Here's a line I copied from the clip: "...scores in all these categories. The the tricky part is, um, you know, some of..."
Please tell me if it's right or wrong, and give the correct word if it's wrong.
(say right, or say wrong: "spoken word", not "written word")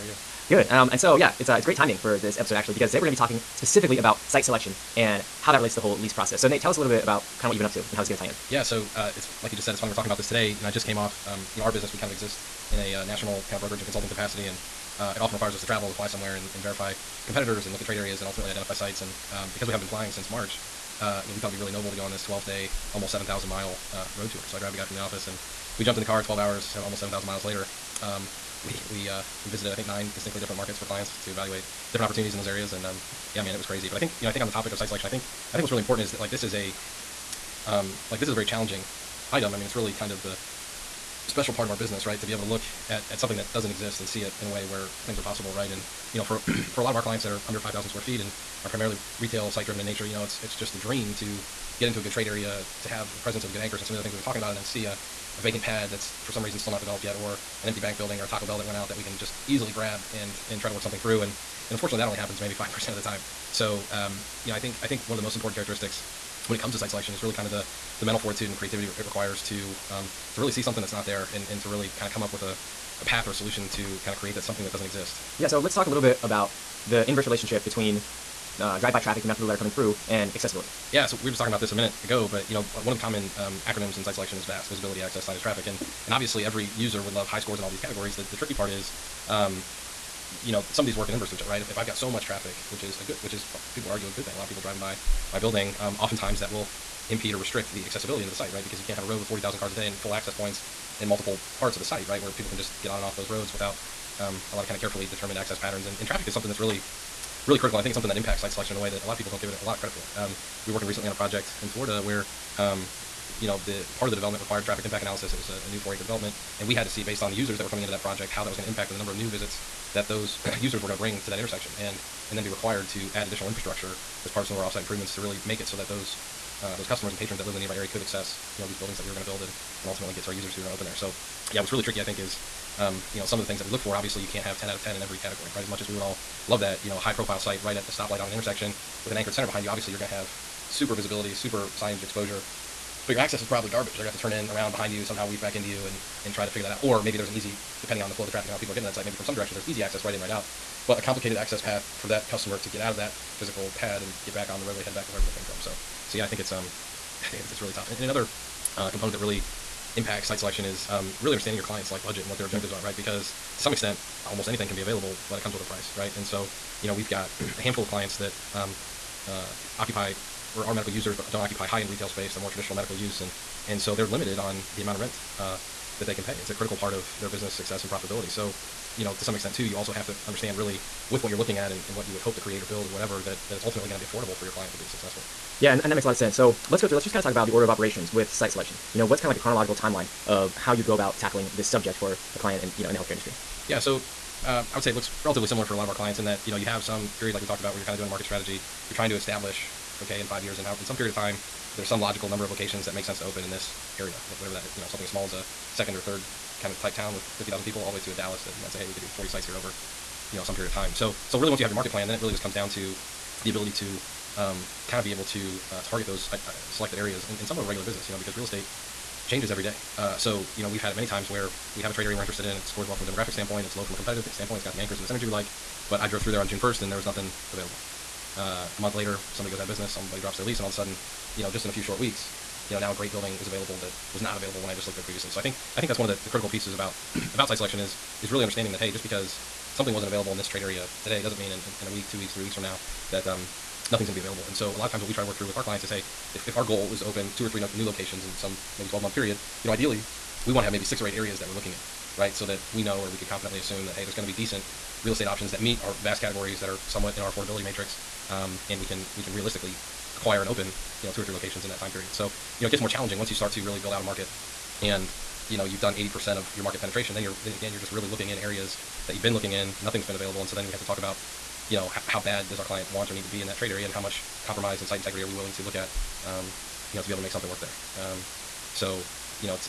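right.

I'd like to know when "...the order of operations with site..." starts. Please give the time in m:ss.
3:07.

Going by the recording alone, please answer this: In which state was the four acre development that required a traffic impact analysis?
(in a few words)
Florida.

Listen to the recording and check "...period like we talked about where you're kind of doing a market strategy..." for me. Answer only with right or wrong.
right.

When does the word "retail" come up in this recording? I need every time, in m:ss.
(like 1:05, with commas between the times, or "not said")
0:49, 2:51.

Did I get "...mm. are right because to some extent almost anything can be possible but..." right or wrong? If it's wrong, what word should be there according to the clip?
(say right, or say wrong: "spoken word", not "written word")
wrong: "available", not "possible".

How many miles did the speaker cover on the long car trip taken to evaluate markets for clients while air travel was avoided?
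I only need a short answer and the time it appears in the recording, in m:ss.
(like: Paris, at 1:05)
7,000, at 0:23.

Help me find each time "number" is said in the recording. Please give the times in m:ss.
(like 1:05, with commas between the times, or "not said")
1:58, 3:22.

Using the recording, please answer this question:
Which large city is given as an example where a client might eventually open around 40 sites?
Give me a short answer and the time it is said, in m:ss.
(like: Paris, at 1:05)
Dallas, at 3:28.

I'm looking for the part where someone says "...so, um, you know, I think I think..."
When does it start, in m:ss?
1:03.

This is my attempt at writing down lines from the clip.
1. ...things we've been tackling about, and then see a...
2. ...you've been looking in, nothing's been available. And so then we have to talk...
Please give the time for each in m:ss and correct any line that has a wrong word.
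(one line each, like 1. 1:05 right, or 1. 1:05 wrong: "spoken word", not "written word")
1. 0:54 wrong: "talking", not "tackling"
2. 4:29 right.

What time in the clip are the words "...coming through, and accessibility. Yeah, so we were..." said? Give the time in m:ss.
1:19.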